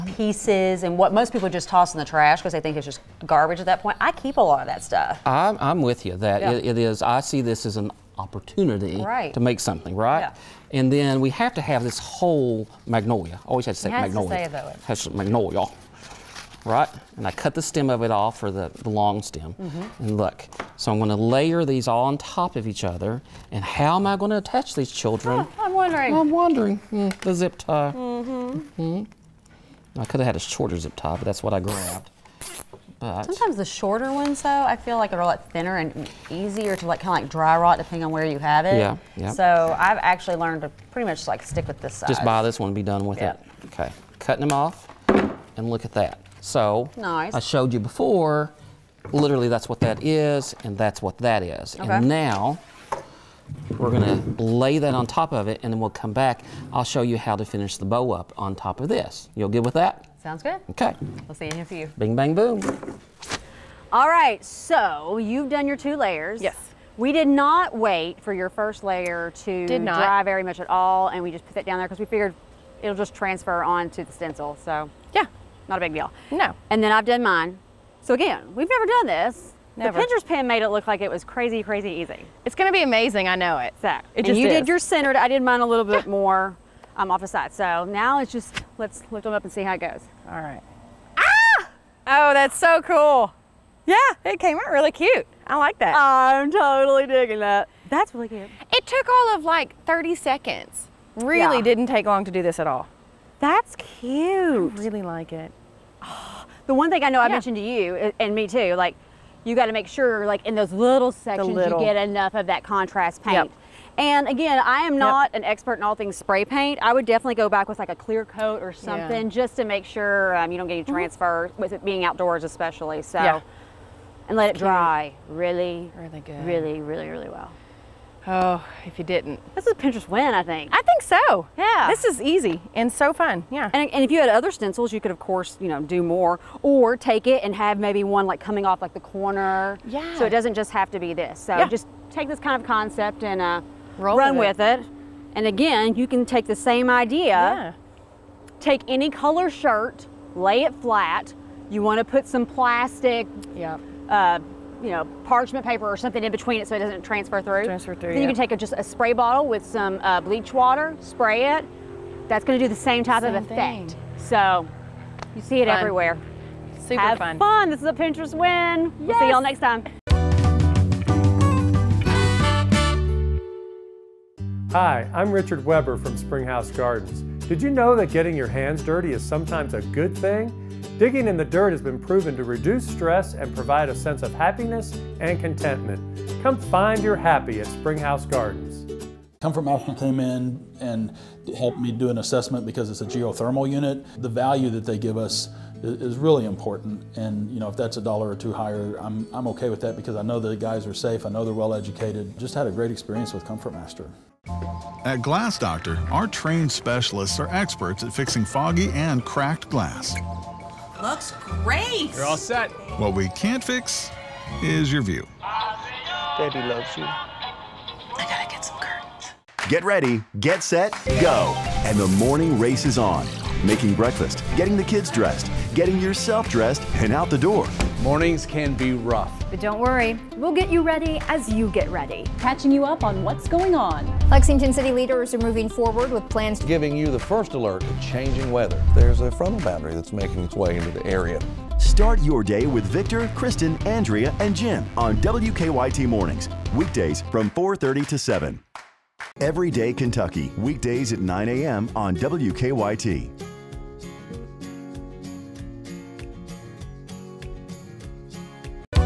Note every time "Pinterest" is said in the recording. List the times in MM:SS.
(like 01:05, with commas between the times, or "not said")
01:20, 02:09, 02:47.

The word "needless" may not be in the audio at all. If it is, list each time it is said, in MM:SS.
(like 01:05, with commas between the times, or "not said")
not said.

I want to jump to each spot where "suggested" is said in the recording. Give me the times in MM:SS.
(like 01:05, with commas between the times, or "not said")
not said.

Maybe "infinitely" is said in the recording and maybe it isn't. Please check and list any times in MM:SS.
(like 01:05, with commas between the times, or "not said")
not said.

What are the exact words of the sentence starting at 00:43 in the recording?
Okay, cutting them off, and look at that.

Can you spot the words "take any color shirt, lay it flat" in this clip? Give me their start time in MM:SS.
02:28.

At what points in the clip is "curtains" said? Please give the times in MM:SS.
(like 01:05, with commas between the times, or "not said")
03:38.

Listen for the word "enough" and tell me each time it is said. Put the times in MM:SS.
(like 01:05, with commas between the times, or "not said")
01:51.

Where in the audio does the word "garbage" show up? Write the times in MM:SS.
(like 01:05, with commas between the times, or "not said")
00:03.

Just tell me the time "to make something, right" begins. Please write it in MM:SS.
00:09.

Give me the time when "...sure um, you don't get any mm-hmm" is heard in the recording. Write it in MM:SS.
01:59.